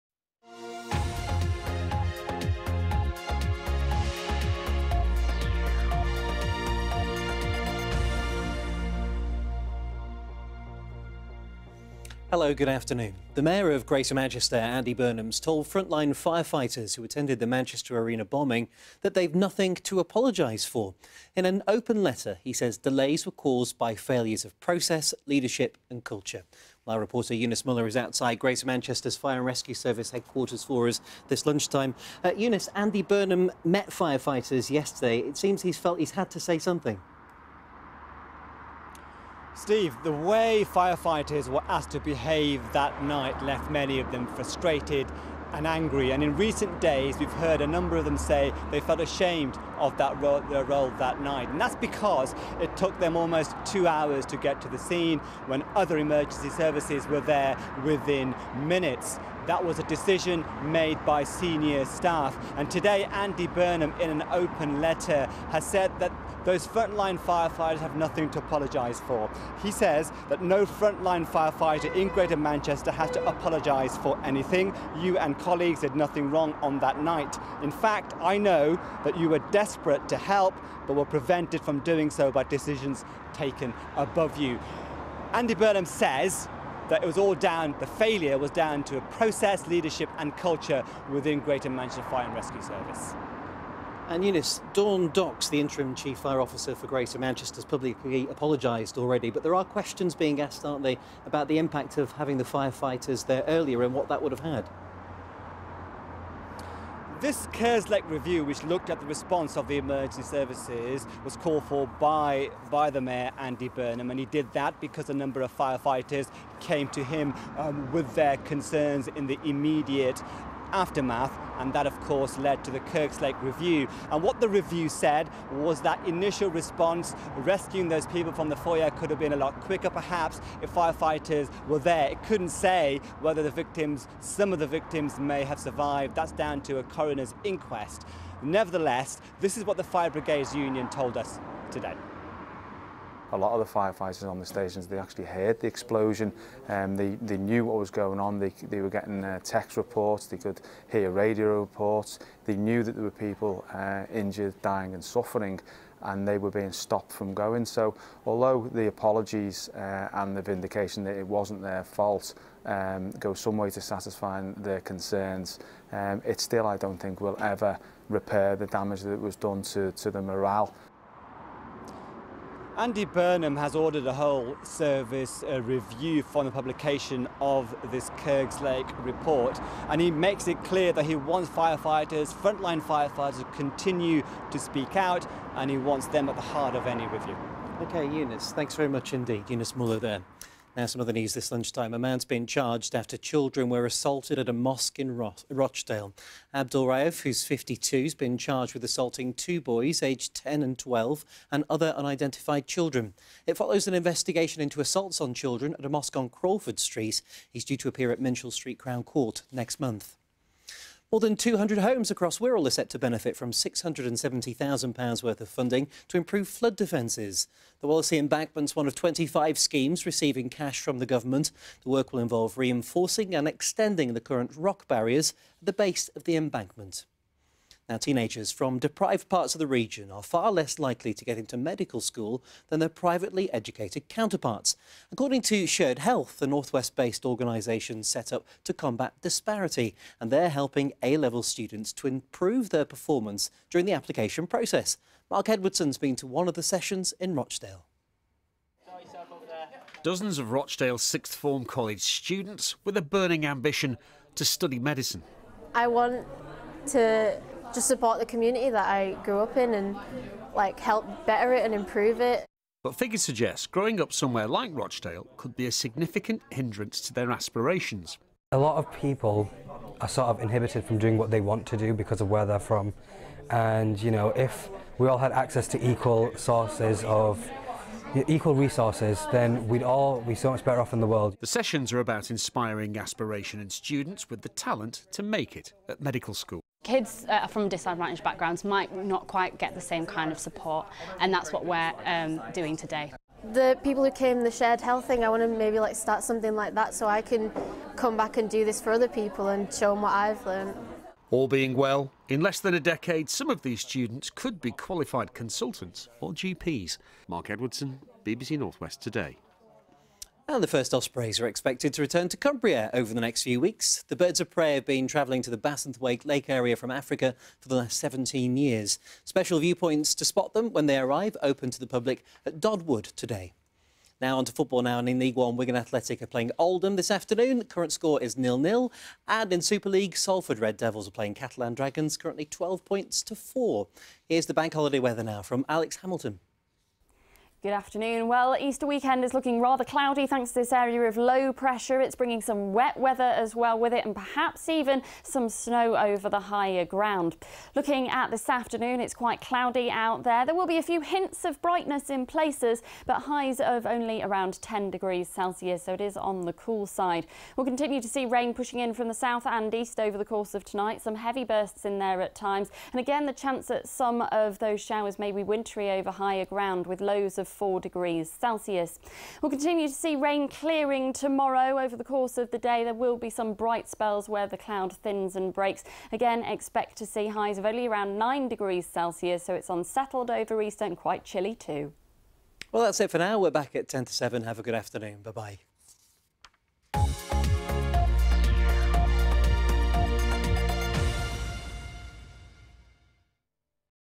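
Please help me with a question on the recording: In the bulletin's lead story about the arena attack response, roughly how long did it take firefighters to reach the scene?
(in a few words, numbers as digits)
almost two hours.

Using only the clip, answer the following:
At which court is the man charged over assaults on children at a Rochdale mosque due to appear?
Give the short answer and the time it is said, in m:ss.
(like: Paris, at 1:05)
Minshull Street Crown Court, at 3:28.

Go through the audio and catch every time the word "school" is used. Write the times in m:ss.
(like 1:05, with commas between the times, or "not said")
3:51, 4:46.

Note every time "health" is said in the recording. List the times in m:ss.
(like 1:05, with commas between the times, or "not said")
3:55, 4:54.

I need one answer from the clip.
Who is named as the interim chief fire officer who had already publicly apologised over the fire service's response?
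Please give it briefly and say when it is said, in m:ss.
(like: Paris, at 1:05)
Dawn Docx, at 1:34.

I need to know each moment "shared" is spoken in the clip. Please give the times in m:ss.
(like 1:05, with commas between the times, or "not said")
3:55, 4:54.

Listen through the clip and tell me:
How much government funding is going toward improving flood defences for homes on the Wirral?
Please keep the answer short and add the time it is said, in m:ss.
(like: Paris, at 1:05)
£670,000, at 3:33.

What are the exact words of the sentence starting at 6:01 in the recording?
Some heavy bursts in there at times.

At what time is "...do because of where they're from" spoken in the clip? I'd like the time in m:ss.
4:31.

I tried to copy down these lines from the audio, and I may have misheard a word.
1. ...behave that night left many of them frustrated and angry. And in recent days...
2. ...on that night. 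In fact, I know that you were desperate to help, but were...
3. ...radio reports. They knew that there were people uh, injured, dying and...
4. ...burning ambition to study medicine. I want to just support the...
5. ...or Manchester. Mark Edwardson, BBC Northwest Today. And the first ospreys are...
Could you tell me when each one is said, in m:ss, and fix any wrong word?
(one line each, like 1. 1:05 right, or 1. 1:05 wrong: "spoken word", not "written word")
1. 0:41 right
2. 1:16 right
3. 2:31 right
4. 4:13 right
5. 5:06 wrong: "GPs", not "Manchester".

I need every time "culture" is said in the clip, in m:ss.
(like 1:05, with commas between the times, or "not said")
0:26, 1:30.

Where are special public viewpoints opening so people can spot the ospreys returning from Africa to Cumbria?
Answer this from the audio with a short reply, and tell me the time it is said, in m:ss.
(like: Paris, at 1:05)
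Dodd Wood, at 5:22.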